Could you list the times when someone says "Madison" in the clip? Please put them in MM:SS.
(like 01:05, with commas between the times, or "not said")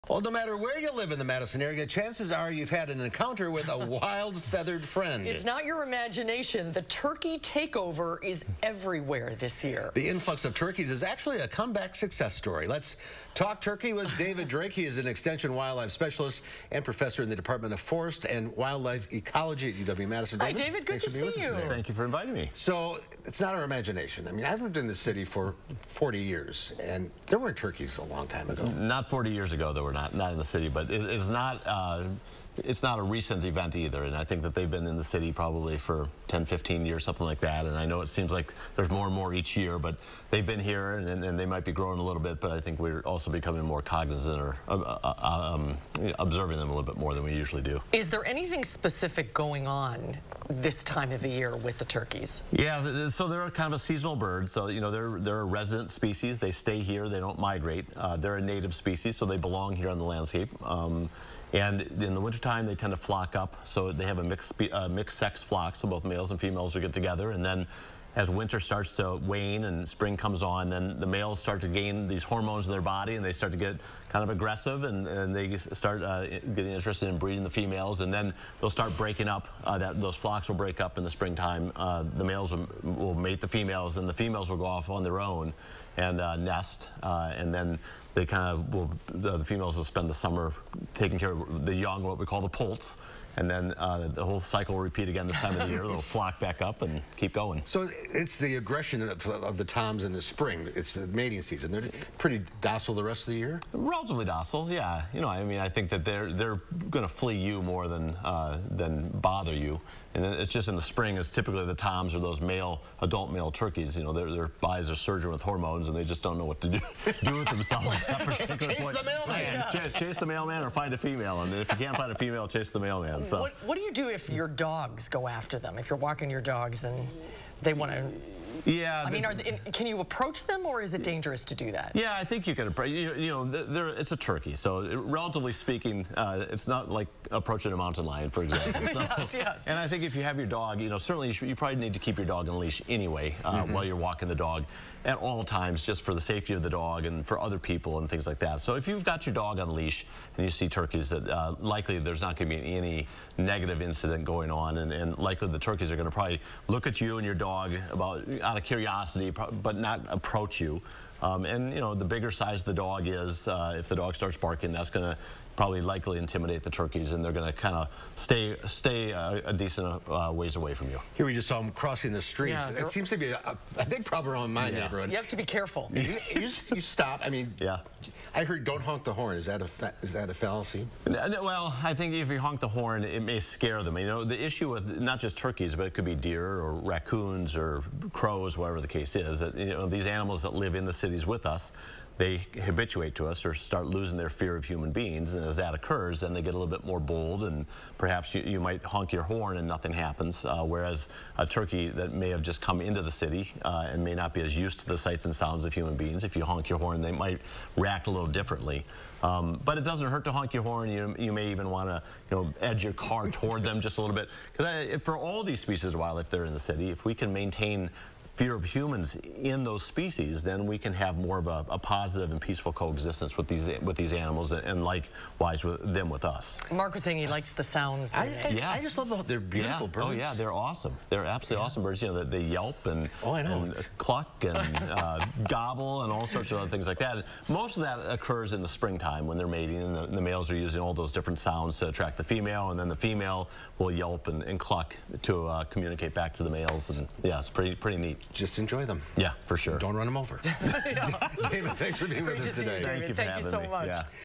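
00:01, 00:19.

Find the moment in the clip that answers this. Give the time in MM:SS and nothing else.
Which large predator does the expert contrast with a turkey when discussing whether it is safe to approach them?
02:17.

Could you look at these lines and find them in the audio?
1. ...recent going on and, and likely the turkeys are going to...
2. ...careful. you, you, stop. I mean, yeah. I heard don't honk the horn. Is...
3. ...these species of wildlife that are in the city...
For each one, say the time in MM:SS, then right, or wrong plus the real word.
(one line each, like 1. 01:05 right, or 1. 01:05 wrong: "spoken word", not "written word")
1. 02:33 wrong: "incident", not "recent"
2. 02:55 right
3. 03:35 right.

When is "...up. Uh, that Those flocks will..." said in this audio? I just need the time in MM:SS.
01:19.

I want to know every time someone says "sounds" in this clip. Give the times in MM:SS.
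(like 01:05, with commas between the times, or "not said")
03:25, 03:47, 04:01.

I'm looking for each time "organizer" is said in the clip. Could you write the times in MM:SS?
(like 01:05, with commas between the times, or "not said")
not said.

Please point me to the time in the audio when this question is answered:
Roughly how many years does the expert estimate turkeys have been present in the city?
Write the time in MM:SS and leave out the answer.
00:36.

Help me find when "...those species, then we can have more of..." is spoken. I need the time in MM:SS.
03:39.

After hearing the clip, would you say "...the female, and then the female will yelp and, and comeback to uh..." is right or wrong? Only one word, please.
wrong.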